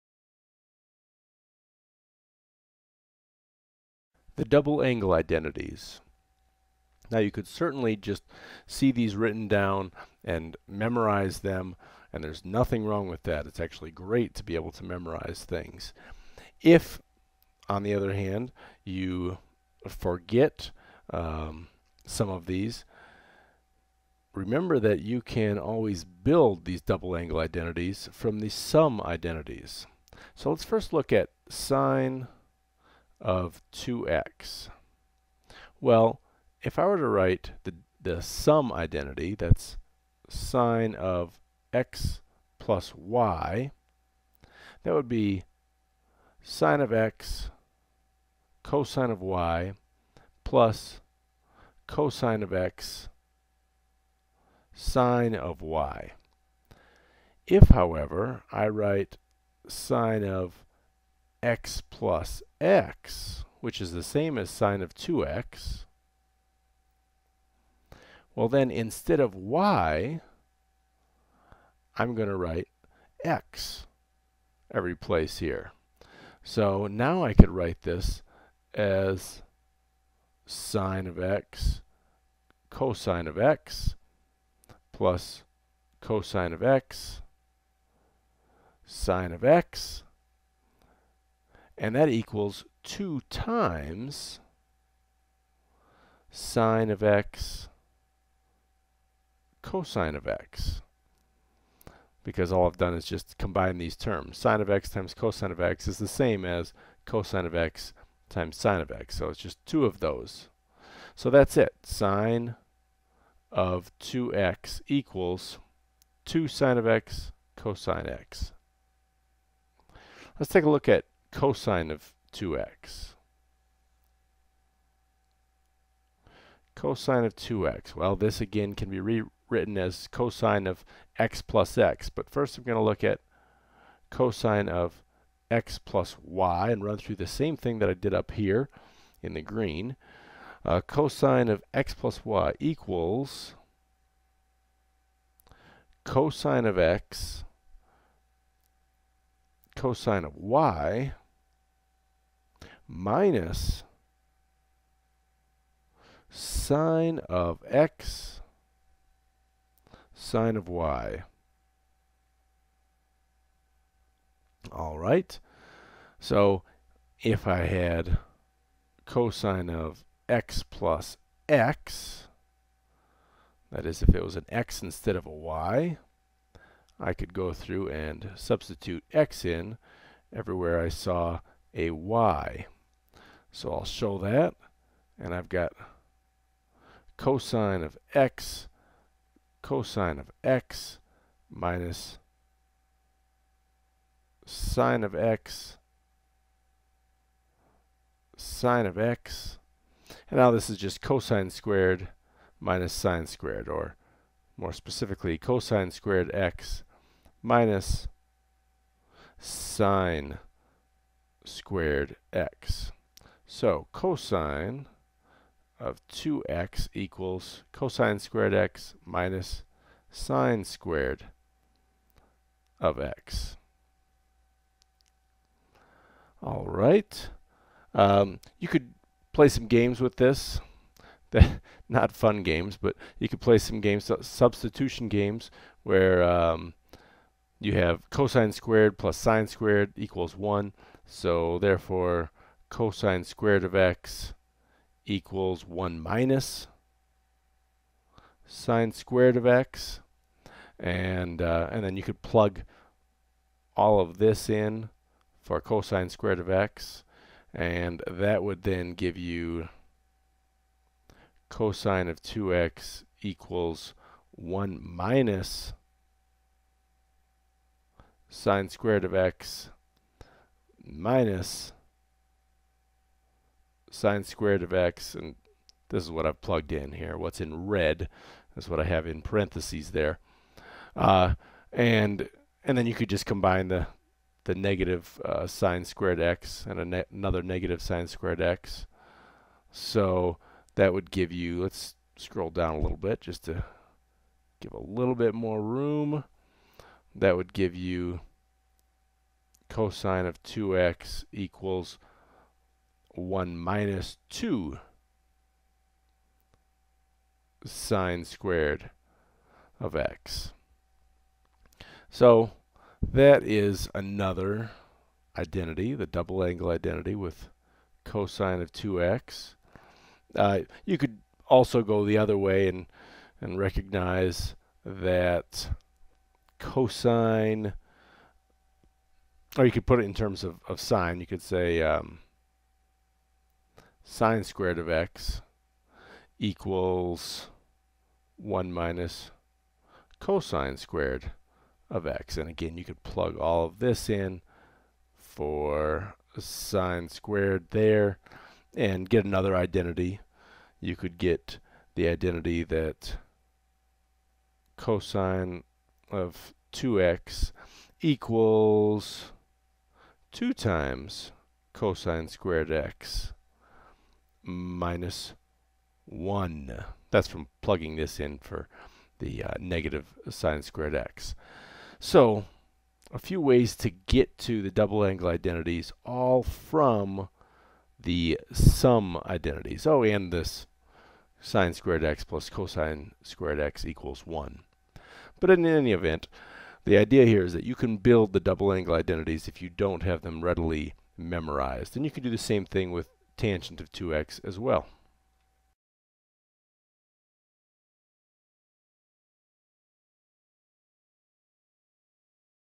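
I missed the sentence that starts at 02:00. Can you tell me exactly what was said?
Let's take a look at cosine of 2x.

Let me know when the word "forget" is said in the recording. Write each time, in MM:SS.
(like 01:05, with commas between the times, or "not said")
00:19.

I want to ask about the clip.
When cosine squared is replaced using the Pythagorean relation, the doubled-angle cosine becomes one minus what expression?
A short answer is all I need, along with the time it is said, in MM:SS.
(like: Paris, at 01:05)
2 sine squared of x, at 05:04.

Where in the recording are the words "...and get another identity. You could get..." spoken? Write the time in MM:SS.
05:48.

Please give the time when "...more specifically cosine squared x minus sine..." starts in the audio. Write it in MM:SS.
03:24.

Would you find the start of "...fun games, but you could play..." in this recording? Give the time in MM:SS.
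03:52.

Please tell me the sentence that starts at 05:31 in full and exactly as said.
You could say um, sine squared of x equals 1 minus cosine squared of x.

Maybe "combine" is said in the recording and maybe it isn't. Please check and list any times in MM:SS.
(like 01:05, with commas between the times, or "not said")
01:43, 04:43.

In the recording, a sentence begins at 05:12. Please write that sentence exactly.
So that is another identity, the double angle identity with cosine of 2x.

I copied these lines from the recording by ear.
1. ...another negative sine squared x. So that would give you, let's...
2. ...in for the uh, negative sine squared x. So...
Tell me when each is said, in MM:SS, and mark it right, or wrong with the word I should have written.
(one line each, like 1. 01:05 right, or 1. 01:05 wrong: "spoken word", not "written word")
1. 04:47 right
2. 06:08 right.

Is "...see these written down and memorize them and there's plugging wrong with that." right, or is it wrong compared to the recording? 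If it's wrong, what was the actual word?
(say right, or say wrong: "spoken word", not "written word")
wrong: "nothing", not "plugging".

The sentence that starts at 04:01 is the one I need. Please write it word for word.
So therefore, cosine squared of x equals 1 minus sine squared of x.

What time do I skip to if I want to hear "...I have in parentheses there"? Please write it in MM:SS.
04:38.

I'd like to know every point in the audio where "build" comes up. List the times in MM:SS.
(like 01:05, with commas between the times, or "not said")
00:26, 06:27.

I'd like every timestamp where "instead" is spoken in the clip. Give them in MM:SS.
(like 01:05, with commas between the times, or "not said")
01:08, 02:54.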